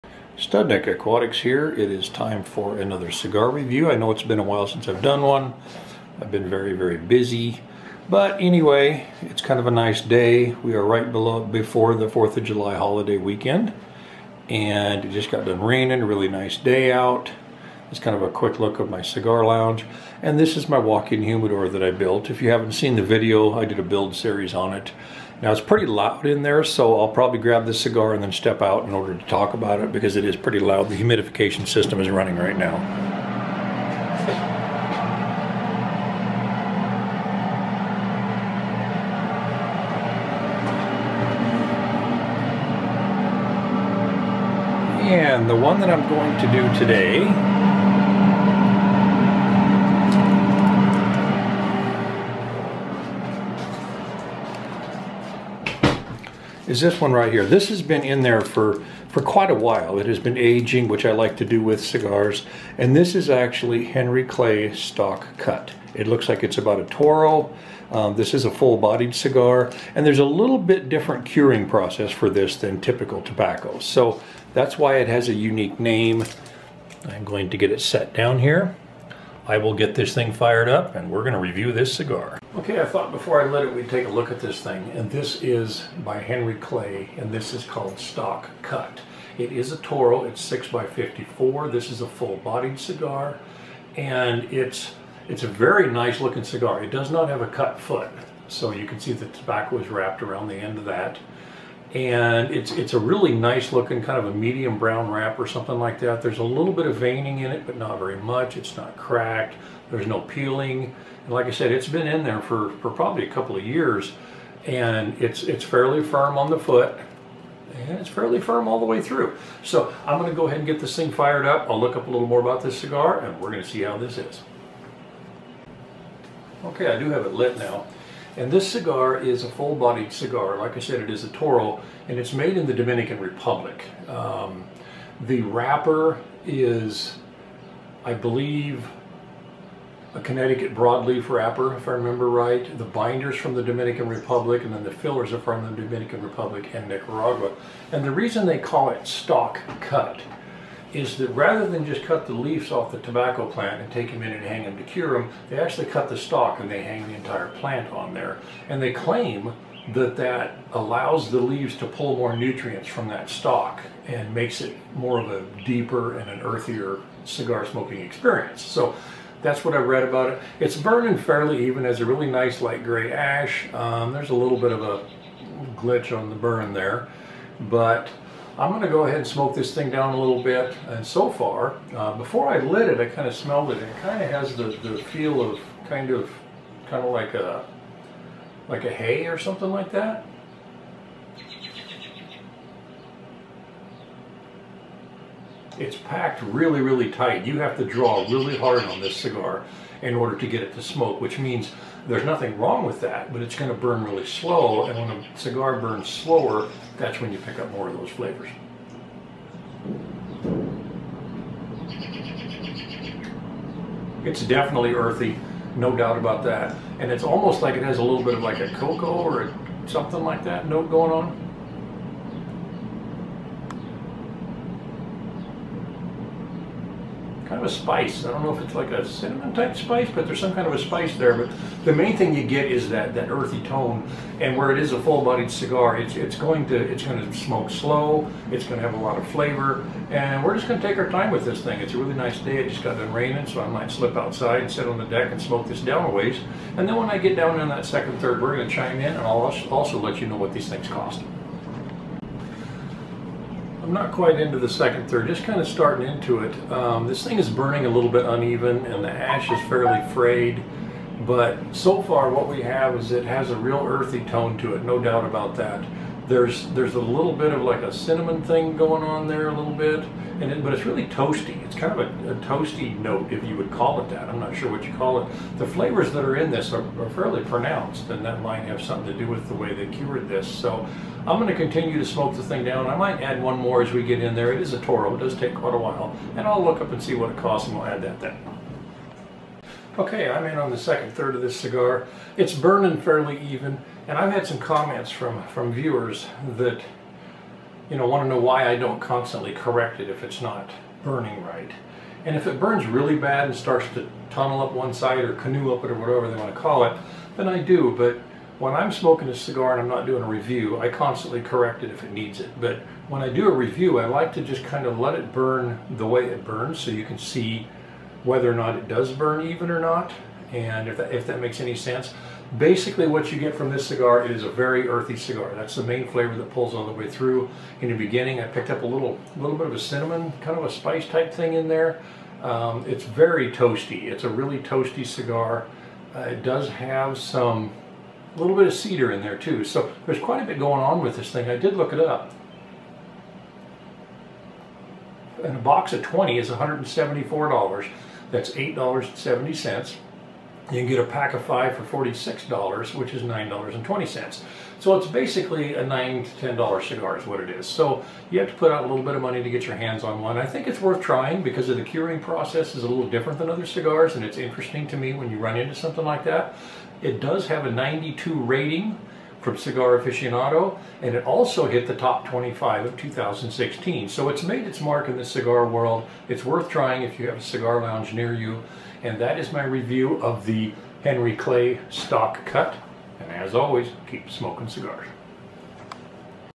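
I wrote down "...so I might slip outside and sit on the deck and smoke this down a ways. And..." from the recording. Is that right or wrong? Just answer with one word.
right.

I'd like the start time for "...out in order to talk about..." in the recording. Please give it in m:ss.
0:28.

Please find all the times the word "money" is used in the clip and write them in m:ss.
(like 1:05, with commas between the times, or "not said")
5:59.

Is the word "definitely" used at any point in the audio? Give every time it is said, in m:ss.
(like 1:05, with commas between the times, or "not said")
3:34.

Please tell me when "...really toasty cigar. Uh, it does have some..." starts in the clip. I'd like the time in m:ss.
5:34.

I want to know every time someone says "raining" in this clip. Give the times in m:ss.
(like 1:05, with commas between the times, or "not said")
0:15, 4:03.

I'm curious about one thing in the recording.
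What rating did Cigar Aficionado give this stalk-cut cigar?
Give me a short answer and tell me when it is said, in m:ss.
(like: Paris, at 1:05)
92, at 6:07.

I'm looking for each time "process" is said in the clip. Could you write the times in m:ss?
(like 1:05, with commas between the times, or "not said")
1:11, 6:02.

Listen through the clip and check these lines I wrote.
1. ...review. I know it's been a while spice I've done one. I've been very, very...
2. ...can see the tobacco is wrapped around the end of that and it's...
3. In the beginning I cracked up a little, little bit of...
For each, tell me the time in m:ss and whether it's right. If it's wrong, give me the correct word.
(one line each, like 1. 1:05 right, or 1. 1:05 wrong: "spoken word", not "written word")
1. 0:03 wrong: "since", not "spice"
2. 1:38 right
3. 5:27 wrong: "picked", not "cracked".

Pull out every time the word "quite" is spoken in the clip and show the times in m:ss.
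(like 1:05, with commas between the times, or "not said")
0:59, 4:14, 4:45, 5:40.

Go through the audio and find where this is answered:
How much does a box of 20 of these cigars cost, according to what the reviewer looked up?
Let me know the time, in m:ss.
5:46.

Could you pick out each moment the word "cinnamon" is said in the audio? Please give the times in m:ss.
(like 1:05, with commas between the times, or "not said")
3:49, 4:27, 5:29.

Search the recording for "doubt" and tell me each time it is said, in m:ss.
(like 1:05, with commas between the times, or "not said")
3:35, 4:24.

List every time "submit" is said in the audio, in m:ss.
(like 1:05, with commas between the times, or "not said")
not said.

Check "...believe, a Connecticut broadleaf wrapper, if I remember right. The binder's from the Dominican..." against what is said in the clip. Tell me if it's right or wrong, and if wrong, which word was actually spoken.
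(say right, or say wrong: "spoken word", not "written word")
right.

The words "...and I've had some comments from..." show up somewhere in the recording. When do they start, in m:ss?
4:54.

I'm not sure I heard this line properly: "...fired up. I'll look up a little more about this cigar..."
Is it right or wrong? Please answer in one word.
right.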